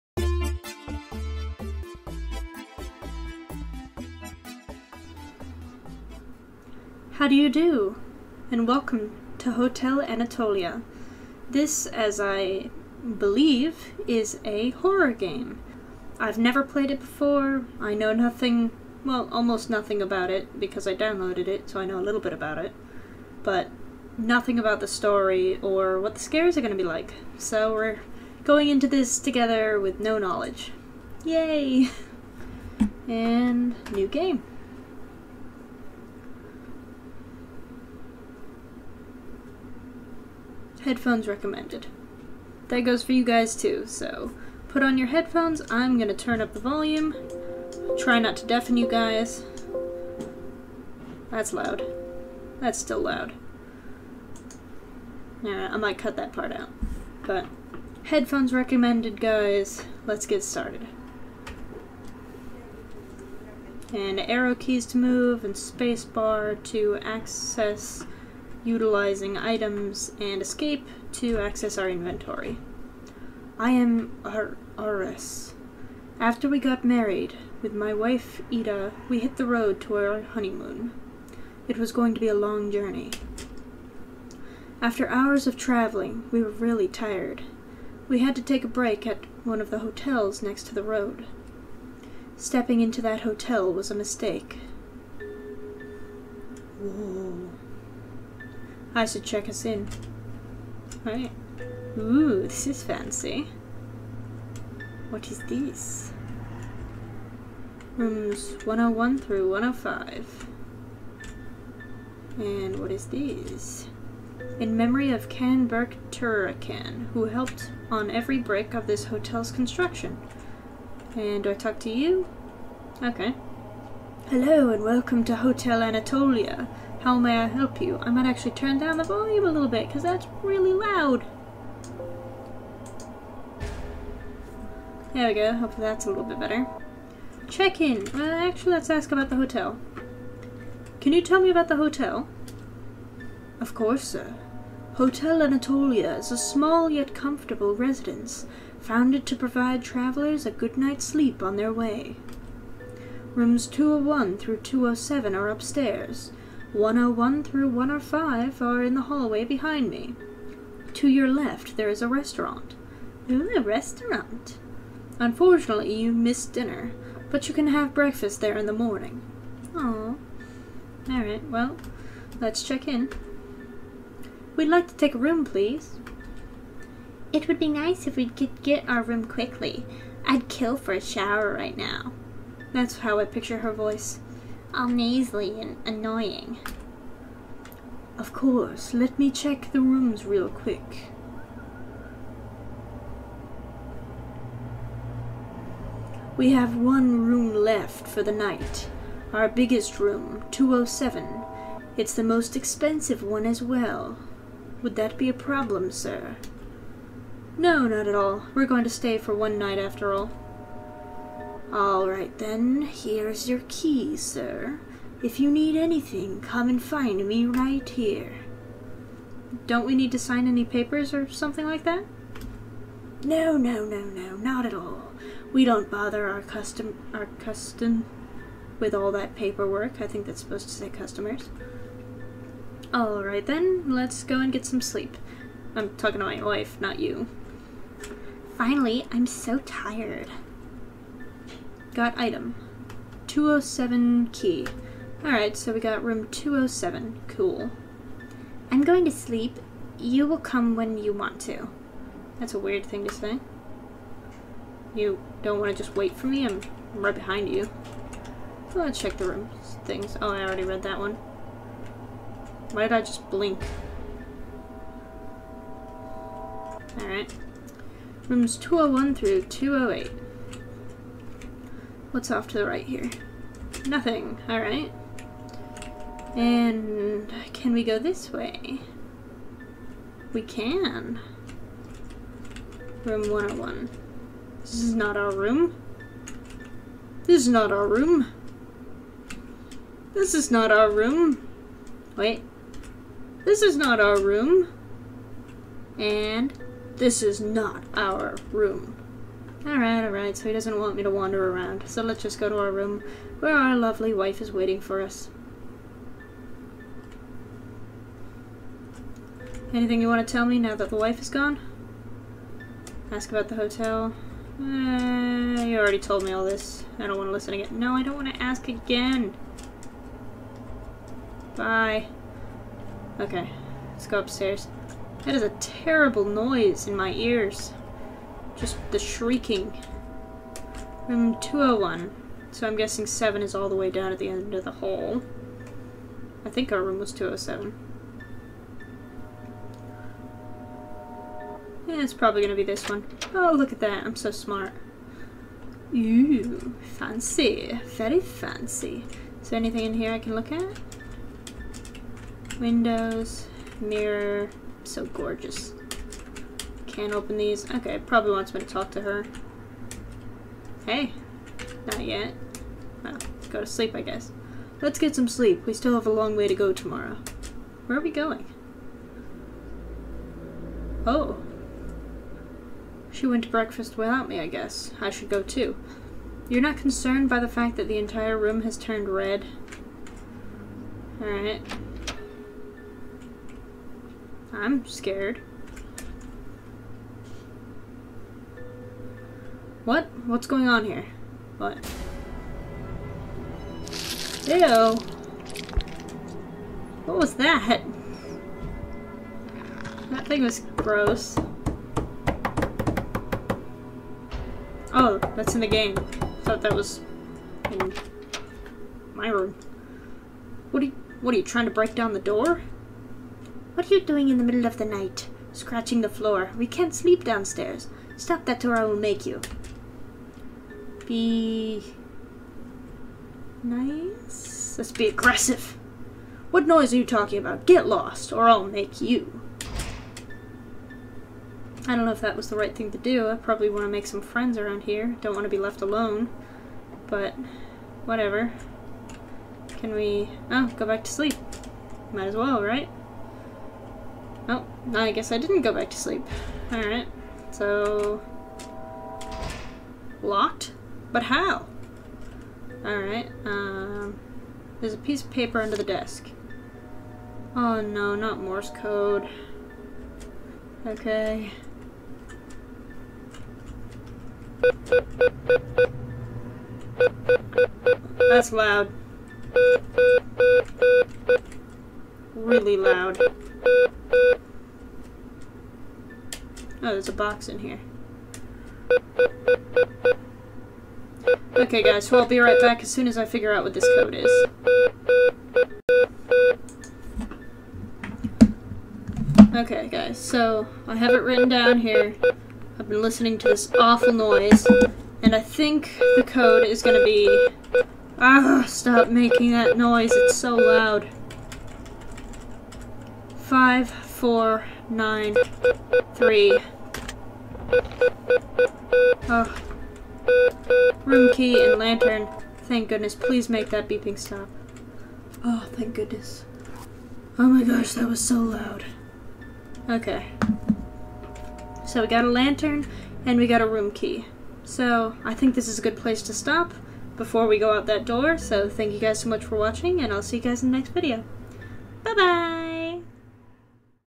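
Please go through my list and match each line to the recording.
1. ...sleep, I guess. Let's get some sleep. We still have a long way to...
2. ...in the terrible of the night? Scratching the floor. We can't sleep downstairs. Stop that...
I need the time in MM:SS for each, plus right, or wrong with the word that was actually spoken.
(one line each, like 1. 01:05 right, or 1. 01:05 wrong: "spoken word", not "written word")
1. 06:03 right
2. 06:54 wrong: "middle", not "terrible".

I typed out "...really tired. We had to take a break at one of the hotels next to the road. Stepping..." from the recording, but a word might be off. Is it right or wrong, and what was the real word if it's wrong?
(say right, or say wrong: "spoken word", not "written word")
right.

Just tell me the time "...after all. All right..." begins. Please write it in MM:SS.
03:29.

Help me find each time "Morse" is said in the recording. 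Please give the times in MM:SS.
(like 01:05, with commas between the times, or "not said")
07:38.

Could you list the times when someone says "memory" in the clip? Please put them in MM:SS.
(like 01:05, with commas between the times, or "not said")
01:54.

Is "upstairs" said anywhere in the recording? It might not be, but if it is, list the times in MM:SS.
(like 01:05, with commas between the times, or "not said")
02:35, 05:24.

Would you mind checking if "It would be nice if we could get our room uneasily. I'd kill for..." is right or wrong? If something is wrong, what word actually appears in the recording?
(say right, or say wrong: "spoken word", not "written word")
wrong: "quickly", not "uneasily".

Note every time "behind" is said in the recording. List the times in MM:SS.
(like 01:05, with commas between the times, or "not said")
02:39, 04:17.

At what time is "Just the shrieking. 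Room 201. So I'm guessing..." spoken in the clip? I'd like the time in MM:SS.
05:28.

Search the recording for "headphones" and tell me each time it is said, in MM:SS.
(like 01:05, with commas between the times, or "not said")
00:40, 00:45, 00:58.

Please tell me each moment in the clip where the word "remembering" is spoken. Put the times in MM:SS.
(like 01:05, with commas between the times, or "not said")
not said.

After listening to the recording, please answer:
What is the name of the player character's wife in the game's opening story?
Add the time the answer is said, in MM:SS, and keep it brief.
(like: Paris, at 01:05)
Ida, at 01:18.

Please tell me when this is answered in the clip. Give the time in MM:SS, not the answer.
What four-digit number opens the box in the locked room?
08:23.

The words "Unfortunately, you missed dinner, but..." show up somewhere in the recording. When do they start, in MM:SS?
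02:45.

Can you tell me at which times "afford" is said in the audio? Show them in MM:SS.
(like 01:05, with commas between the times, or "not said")
not said.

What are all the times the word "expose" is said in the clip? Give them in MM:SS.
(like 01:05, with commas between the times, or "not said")
not said.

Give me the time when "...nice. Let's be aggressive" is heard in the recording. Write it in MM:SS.
07:03.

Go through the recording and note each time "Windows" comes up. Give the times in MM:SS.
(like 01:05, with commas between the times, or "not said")
05:52.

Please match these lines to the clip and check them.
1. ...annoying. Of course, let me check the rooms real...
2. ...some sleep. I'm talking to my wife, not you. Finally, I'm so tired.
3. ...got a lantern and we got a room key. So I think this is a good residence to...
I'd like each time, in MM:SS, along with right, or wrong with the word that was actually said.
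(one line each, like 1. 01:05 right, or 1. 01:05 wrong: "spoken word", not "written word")
1. 03:05 right
2. 03:54 right
3. 08:42 wrong: "place", not "residence".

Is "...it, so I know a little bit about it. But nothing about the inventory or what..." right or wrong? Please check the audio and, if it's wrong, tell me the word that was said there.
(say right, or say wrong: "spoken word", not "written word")
wrong: "story", not "inventory".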